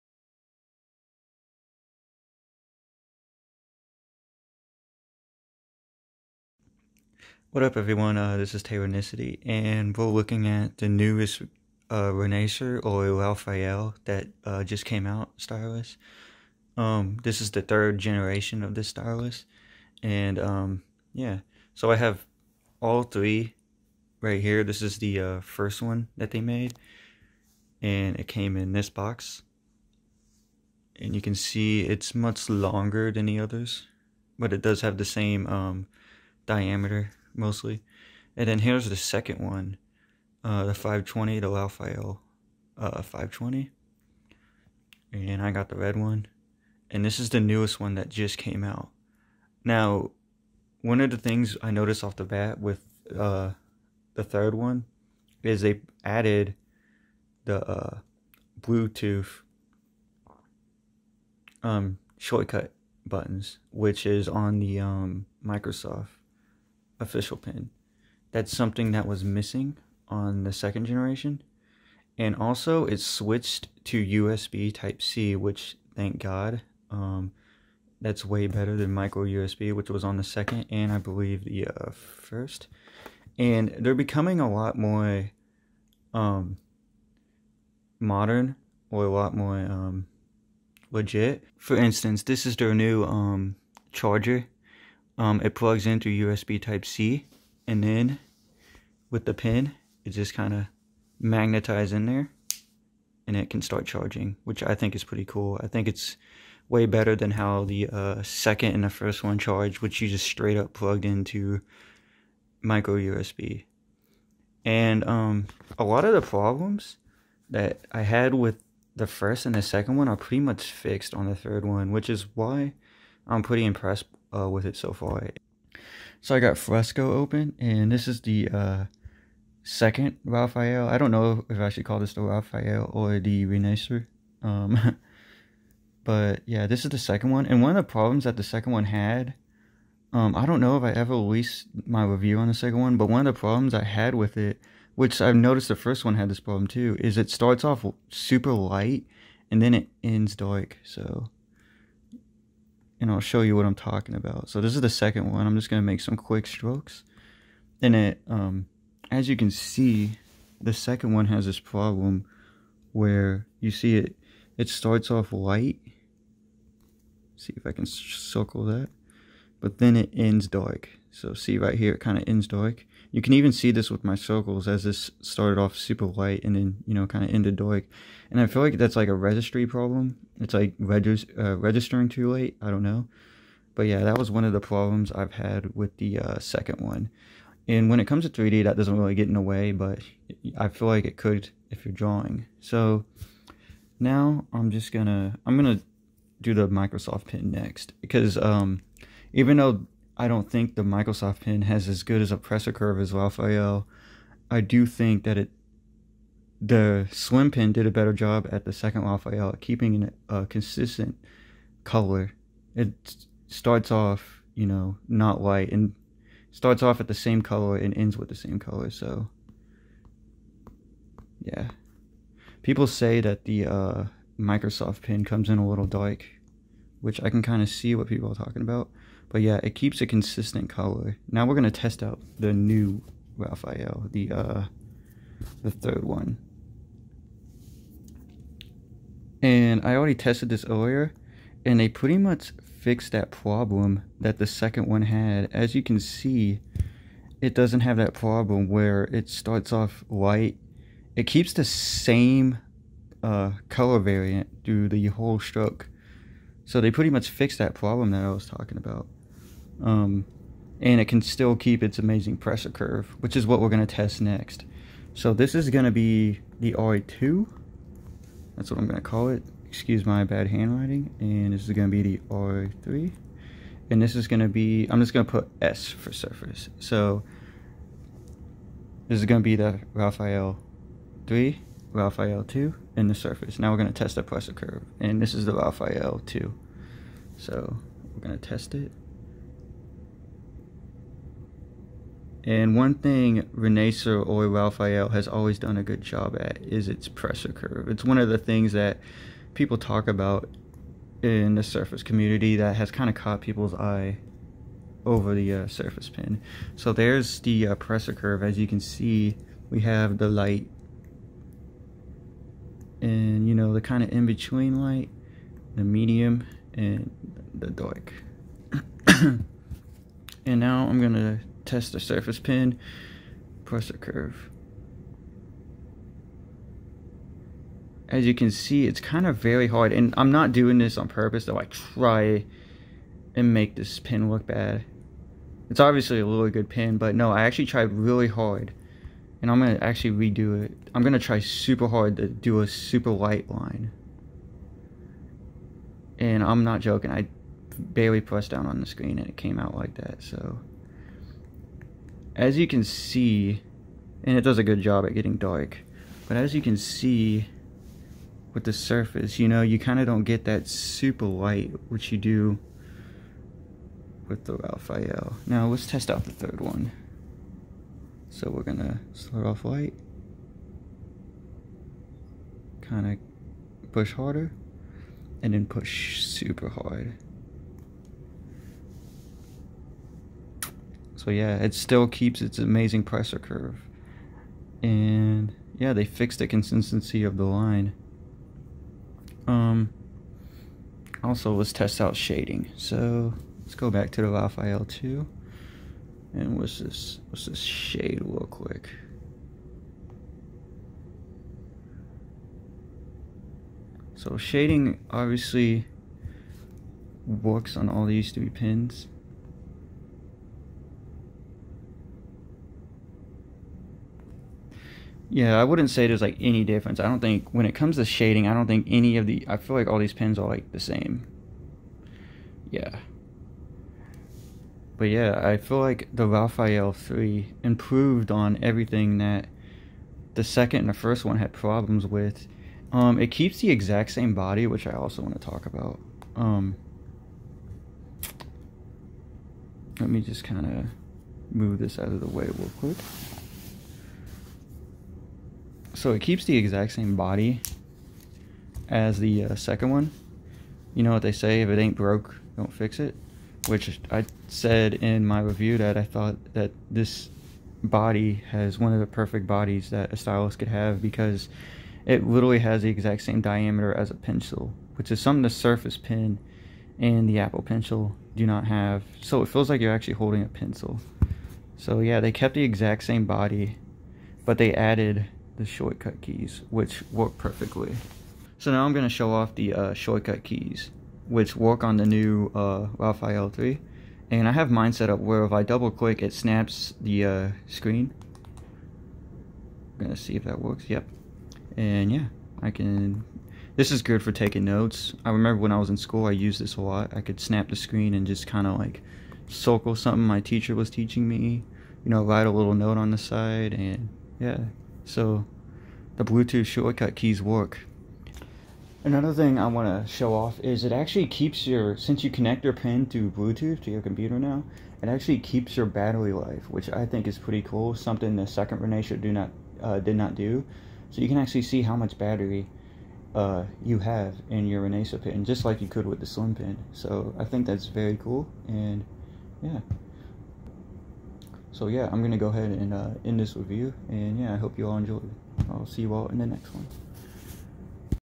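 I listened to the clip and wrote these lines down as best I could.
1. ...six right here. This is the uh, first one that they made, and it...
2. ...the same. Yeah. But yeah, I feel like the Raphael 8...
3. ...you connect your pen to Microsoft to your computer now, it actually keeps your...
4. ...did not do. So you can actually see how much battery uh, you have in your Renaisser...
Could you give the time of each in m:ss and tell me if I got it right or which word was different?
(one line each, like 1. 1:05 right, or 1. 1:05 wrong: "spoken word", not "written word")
1. 0:23 wrong: "three", not "six"
2. 7:00 wrong: "3", not "8"
3. 8:32 wrong: "Bluetooth", not "Microsoft"
4. 8:39 right.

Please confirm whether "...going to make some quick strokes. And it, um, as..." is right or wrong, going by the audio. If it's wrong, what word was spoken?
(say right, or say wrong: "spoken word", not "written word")
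right.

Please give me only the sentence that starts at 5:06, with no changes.
So there's the uh, pressure curve.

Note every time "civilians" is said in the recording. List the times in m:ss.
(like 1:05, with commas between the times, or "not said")
not said.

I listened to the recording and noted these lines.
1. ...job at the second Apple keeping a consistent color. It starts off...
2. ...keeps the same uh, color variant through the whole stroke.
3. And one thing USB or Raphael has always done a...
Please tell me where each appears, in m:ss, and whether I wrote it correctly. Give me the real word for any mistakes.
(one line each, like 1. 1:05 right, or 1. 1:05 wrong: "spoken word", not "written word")
1. 3:28 wrong: "Raphael", not "Apple"
2. 4:11 right
3. 4:52 wrong: "Renaisser", not "USB".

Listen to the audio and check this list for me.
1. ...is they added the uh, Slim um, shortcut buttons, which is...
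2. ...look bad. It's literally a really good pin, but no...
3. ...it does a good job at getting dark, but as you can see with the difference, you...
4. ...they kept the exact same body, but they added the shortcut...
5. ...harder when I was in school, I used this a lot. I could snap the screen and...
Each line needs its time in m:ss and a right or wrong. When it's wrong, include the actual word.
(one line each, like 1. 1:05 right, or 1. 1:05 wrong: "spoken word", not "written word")
1. 0:55 wrong: "Bluetooth", not "Slim"
2. 5:34 wrong: "obviously", not "literally"
3. 5:54 wrong: "surface", not "difference"
4. 7:52 right
5. 8:15 wrong: "remember", not "harder".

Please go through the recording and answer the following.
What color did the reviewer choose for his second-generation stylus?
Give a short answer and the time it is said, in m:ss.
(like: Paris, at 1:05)
Red, at 0:45.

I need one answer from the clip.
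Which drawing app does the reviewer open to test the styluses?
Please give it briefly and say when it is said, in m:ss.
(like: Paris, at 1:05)
Fresco, at 2:06.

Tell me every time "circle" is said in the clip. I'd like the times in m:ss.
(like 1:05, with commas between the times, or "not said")
2:47, 2:54, 8:19.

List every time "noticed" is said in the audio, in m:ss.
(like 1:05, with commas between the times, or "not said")
0:51, 2:25.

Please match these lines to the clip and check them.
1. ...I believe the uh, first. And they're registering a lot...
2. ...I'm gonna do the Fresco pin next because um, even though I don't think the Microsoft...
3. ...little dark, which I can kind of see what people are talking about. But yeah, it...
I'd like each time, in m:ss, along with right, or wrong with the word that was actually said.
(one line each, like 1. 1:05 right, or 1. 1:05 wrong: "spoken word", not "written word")
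1. 1:20 wrong: "becoming", not "registering"
2. 3:15 wrong: "Microsoft", not "Fresco"
3. 3:45 right.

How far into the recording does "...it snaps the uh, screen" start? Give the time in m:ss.
8:06.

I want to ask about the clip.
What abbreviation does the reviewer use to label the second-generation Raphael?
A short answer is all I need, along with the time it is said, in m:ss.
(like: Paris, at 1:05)
RA2, at 4:26.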